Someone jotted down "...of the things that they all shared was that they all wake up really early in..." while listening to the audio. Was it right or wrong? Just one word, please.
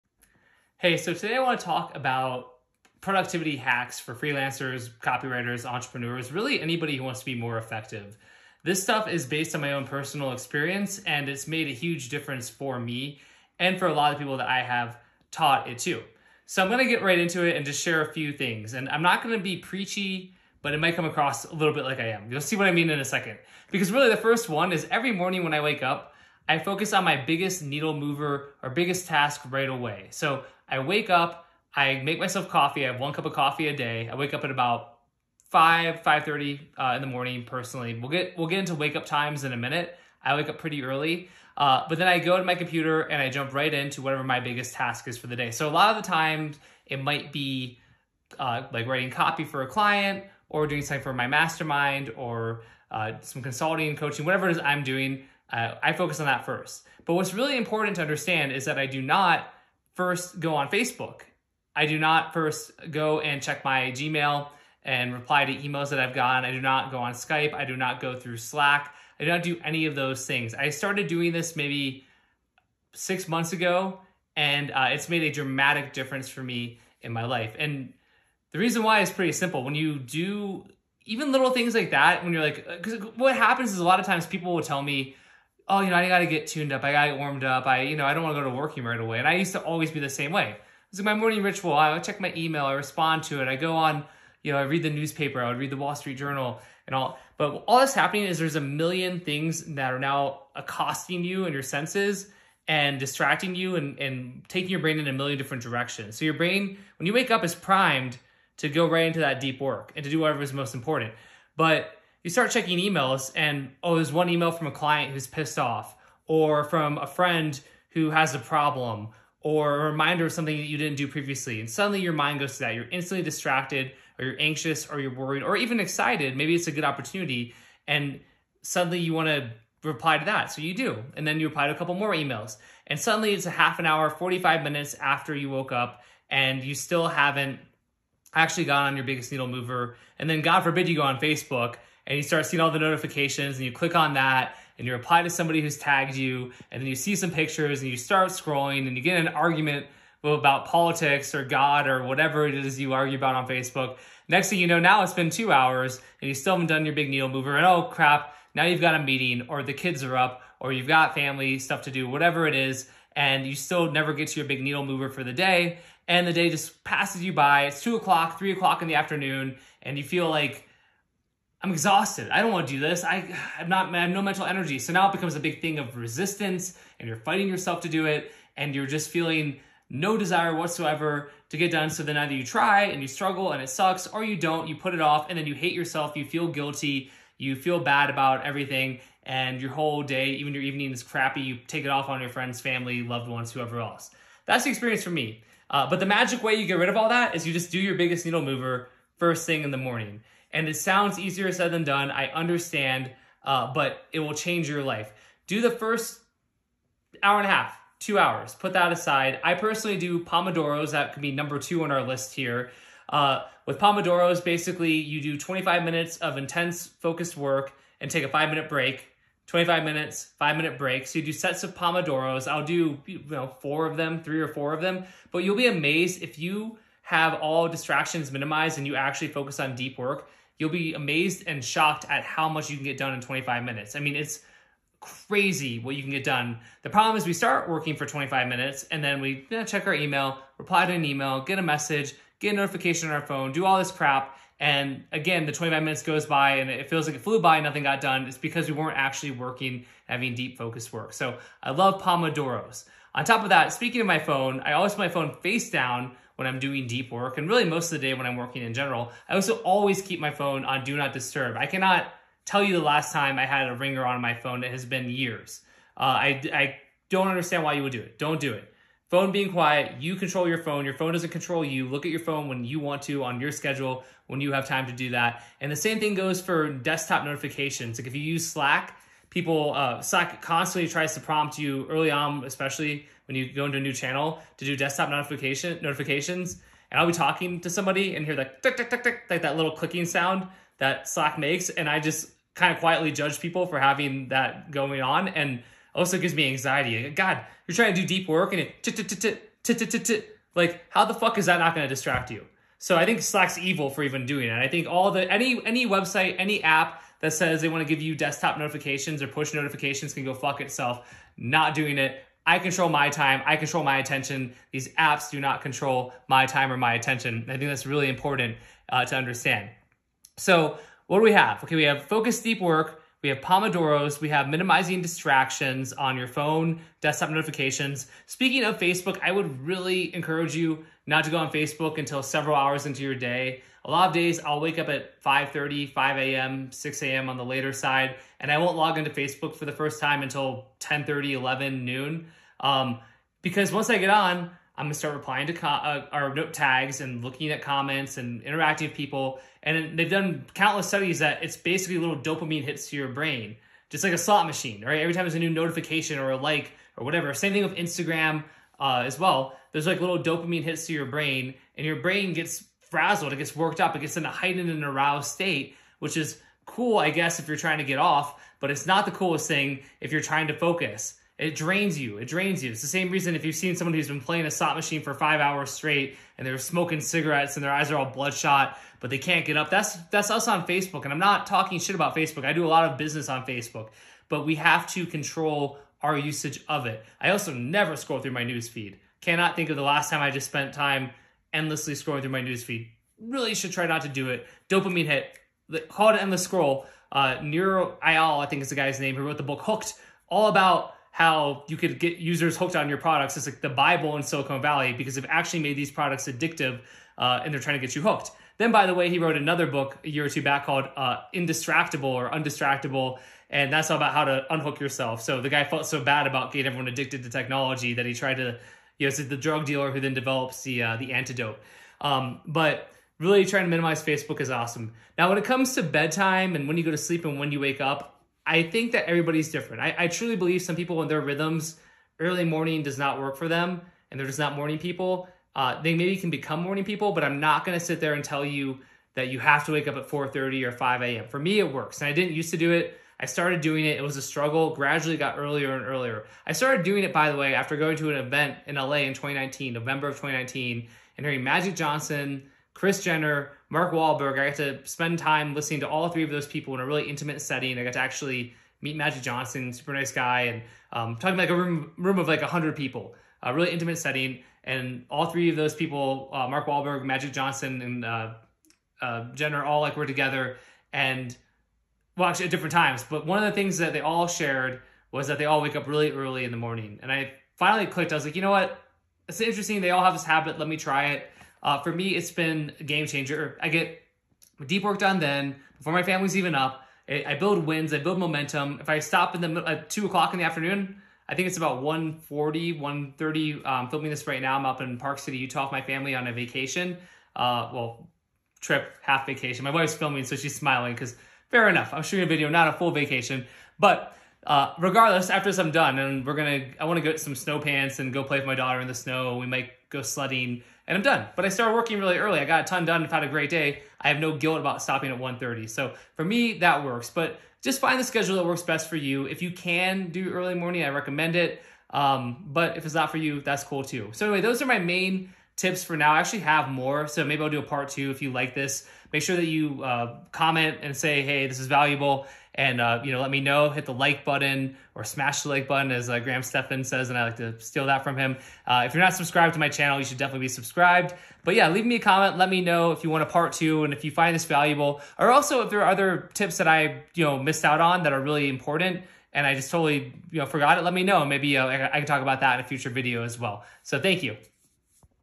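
right.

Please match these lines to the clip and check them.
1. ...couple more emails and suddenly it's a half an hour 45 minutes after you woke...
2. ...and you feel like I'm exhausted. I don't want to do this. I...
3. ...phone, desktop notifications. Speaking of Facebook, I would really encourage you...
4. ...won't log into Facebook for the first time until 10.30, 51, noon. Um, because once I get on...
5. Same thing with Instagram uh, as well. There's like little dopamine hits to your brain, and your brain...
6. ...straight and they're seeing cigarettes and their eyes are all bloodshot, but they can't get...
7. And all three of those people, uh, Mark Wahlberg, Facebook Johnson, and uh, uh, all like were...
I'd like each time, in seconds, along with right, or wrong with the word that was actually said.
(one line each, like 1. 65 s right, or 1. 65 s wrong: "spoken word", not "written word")
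1. 131 s right
2. 169 s right
3. 326 s right
4. 338 s wrong: "11", not "51"
5. 357 s right
6. 375 s wrong: "smoking", not "seeing"
7. 464 s wrong: "Magic", not "Facebook".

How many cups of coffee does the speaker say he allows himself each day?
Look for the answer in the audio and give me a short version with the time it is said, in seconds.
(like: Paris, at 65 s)
1, at 32 s.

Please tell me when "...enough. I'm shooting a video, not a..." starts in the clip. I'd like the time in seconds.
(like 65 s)
501 s.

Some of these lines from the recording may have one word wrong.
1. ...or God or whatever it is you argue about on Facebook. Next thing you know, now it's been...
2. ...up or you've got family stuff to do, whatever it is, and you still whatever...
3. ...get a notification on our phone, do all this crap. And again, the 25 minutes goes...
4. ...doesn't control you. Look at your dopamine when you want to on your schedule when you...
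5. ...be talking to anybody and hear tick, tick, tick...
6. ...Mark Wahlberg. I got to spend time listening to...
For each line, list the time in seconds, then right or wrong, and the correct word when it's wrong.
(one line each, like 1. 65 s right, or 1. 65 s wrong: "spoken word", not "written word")
1. 151 s right
2. 160 s wrong: "never", not "whatever"
3. 242 s right
4. 271 s wrong: "phone", not "dopamine"
5. 287 s wrong: "somebody", not "anybody"
6. 453 s right.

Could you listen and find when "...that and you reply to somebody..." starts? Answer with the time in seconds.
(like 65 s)
144 s.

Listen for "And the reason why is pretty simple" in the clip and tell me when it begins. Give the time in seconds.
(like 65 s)
77 s.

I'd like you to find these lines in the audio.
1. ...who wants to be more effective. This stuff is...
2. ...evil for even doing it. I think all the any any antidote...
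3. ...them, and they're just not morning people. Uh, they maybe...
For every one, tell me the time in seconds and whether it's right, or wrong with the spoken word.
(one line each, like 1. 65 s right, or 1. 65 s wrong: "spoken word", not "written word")
1. 6 s right
2. 303 s wrong: "website", not "antidote"
3. 433 s right.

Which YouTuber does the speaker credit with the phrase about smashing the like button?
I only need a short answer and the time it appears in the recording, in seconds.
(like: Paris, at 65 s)
Graham Stephan, at 536 s.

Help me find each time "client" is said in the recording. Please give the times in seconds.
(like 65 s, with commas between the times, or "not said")
49 s, 114 s.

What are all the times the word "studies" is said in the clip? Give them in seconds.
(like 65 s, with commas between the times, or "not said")
350 s.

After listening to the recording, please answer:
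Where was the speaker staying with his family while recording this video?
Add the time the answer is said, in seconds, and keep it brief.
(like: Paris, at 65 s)
Park City, Utah, at 494 s.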